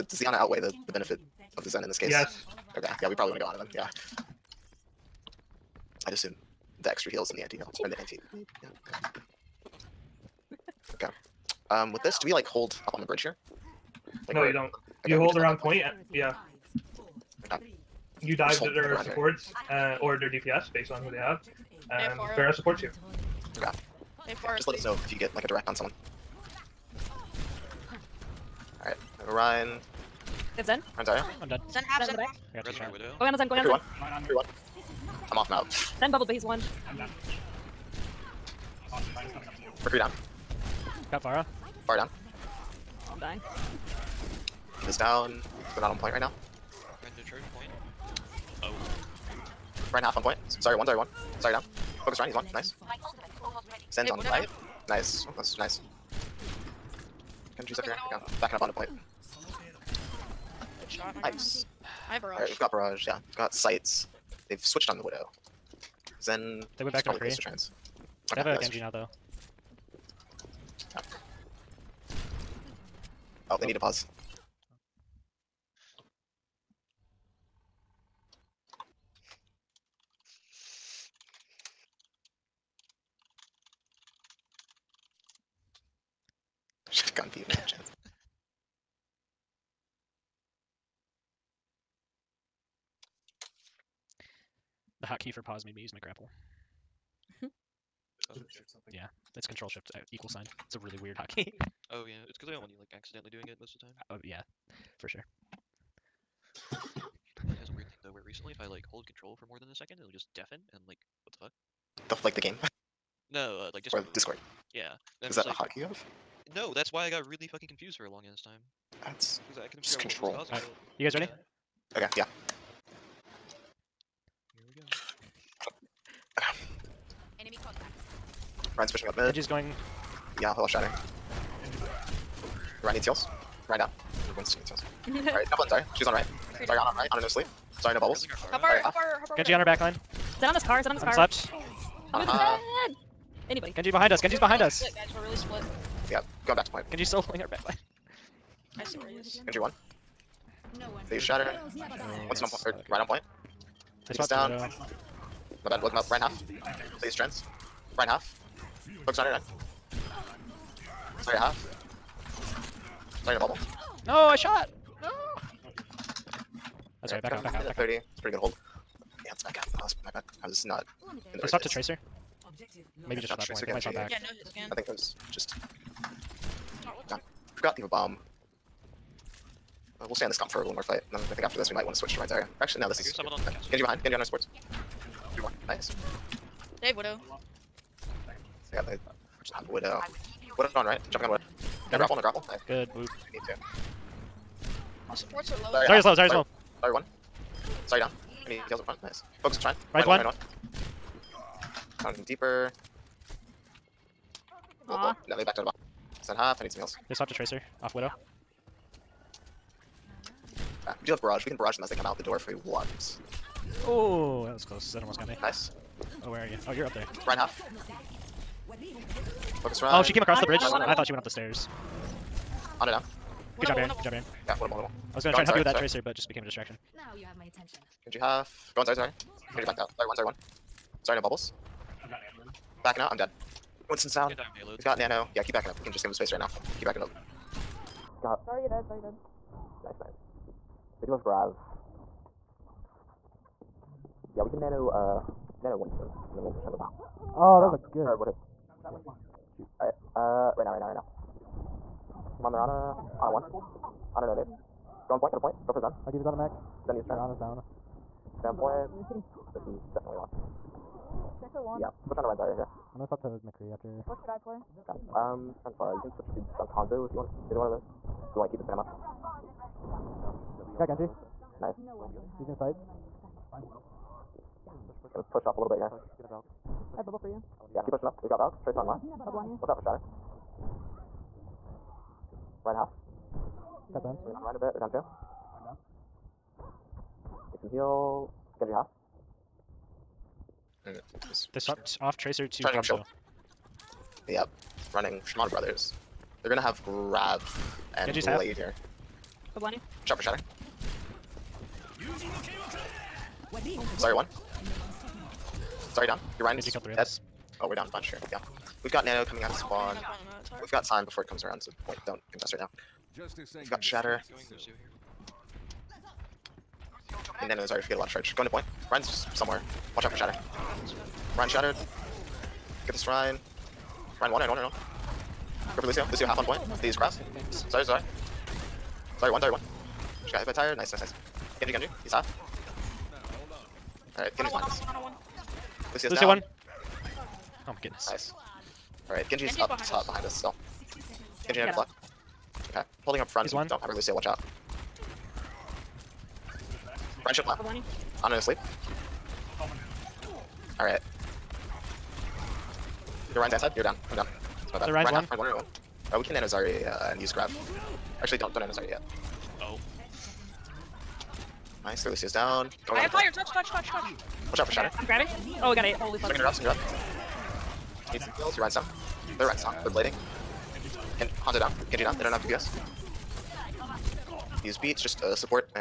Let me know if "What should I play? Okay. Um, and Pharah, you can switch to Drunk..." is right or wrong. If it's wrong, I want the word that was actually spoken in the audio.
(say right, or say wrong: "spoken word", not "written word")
right.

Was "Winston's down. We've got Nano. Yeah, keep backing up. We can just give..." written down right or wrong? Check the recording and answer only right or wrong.
right.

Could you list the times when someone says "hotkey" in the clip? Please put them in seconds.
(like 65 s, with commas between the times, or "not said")
95 s, 101 s, 115 s.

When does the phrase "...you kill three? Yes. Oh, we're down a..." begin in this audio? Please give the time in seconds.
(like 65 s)
306 s.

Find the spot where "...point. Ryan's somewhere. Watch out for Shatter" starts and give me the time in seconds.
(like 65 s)
318 s.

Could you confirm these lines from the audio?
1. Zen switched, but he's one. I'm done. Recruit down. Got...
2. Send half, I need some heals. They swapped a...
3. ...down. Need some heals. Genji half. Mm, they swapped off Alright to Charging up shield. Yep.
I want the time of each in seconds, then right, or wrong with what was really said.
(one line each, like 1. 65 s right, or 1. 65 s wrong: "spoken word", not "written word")
1. 35 s wrong: "bubbled", not "switched"
2. 206 s right
3. 285 s wrong: "Tracer", not "Alright".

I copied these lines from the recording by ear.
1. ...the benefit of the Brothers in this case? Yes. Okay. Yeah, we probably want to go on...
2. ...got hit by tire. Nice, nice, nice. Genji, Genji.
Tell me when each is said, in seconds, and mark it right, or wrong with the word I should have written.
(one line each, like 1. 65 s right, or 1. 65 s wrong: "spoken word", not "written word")
1. 0 s wrong: "Zen", not "Brothers"
2. 330 s right.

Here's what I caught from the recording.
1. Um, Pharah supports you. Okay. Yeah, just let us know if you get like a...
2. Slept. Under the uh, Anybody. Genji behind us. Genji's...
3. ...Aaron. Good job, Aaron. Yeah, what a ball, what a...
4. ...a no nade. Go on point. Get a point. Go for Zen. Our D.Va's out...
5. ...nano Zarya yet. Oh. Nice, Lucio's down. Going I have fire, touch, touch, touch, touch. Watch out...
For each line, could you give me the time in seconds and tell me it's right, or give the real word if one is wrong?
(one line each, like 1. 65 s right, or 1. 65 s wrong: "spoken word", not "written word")
1. 21 s right
2. 141 s right
3. 223 s right
4. 254 s right
5. 358 s right.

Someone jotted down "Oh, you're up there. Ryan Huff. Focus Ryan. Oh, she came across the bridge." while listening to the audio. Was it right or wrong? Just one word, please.
right.